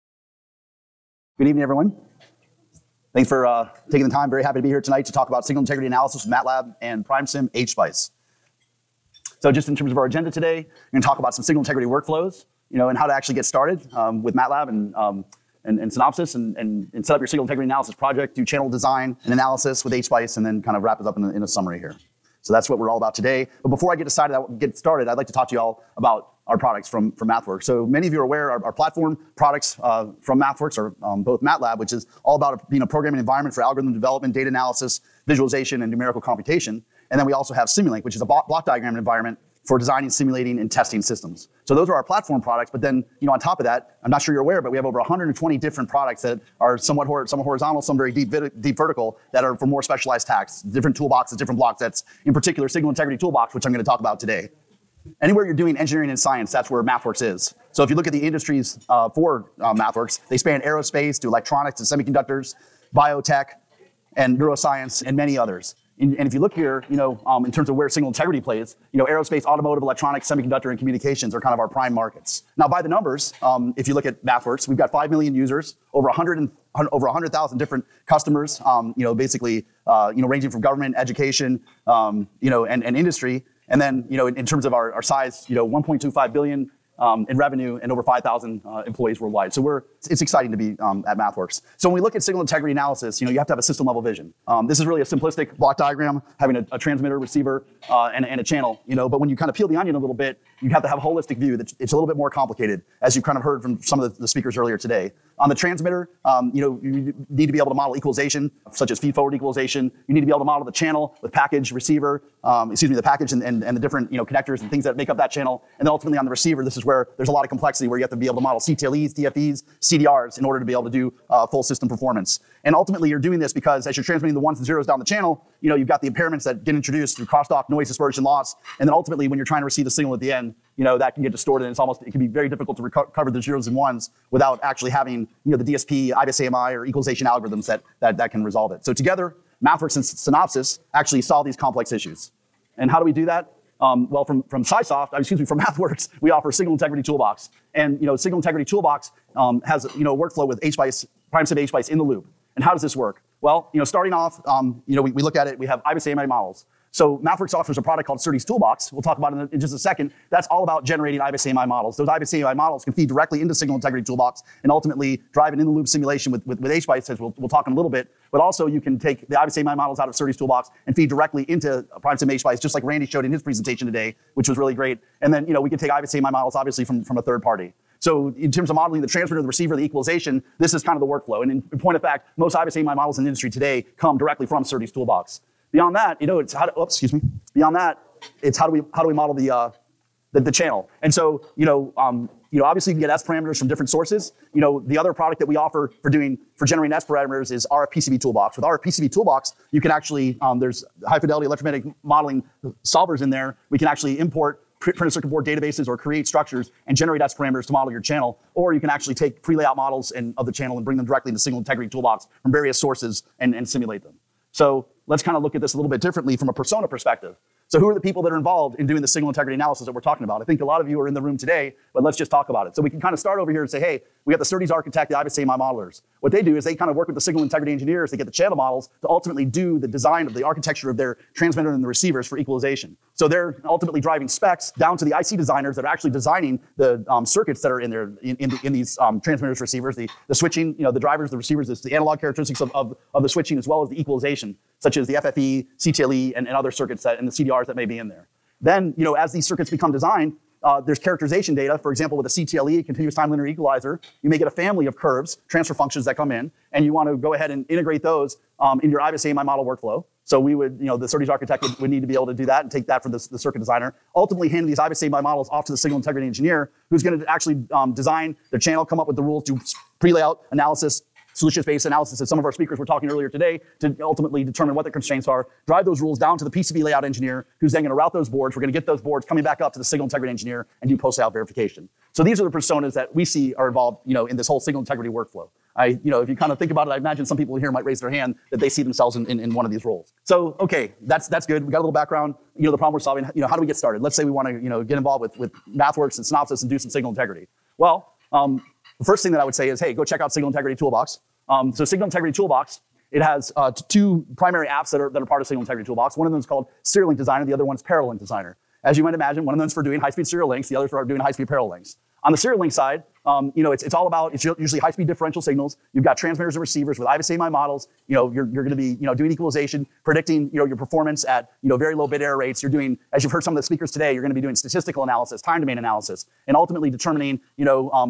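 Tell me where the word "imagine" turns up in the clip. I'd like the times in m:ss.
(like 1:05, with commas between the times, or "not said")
4:46, 5:09.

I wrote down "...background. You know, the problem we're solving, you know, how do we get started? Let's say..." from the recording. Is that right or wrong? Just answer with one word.
right.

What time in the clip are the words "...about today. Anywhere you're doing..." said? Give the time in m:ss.
0:54.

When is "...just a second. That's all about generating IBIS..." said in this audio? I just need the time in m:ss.
2:39.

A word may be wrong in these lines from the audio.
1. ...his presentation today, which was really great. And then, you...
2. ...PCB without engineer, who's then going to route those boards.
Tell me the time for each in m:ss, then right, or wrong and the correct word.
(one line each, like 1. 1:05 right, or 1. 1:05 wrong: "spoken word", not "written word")
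1. 2:53 right
2. 4:36 wrong: "layout", not "without".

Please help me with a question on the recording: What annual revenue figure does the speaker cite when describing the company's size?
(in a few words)
1.25 billion.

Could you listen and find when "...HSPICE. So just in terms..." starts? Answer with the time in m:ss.
0:07.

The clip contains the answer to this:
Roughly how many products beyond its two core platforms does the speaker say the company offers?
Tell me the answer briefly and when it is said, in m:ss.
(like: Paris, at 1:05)
over 120, at 0:44.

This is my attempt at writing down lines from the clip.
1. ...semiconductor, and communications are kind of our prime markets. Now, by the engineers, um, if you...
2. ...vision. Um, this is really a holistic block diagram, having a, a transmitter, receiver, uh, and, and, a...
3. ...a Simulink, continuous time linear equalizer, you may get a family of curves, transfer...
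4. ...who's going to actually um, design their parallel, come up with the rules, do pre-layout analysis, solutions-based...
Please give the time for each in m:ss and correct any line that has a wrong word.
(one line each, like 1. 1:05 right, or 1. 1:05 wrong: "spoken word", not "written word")
1. 1:10 wrong: "numbers", not "engineers"
2. 1:34 wrong: "simplistic", not "holistic"
3. 4:12 wrong: "CTLE", not "Simulink"
4. 4:26 wrong: "channel", not "parallel".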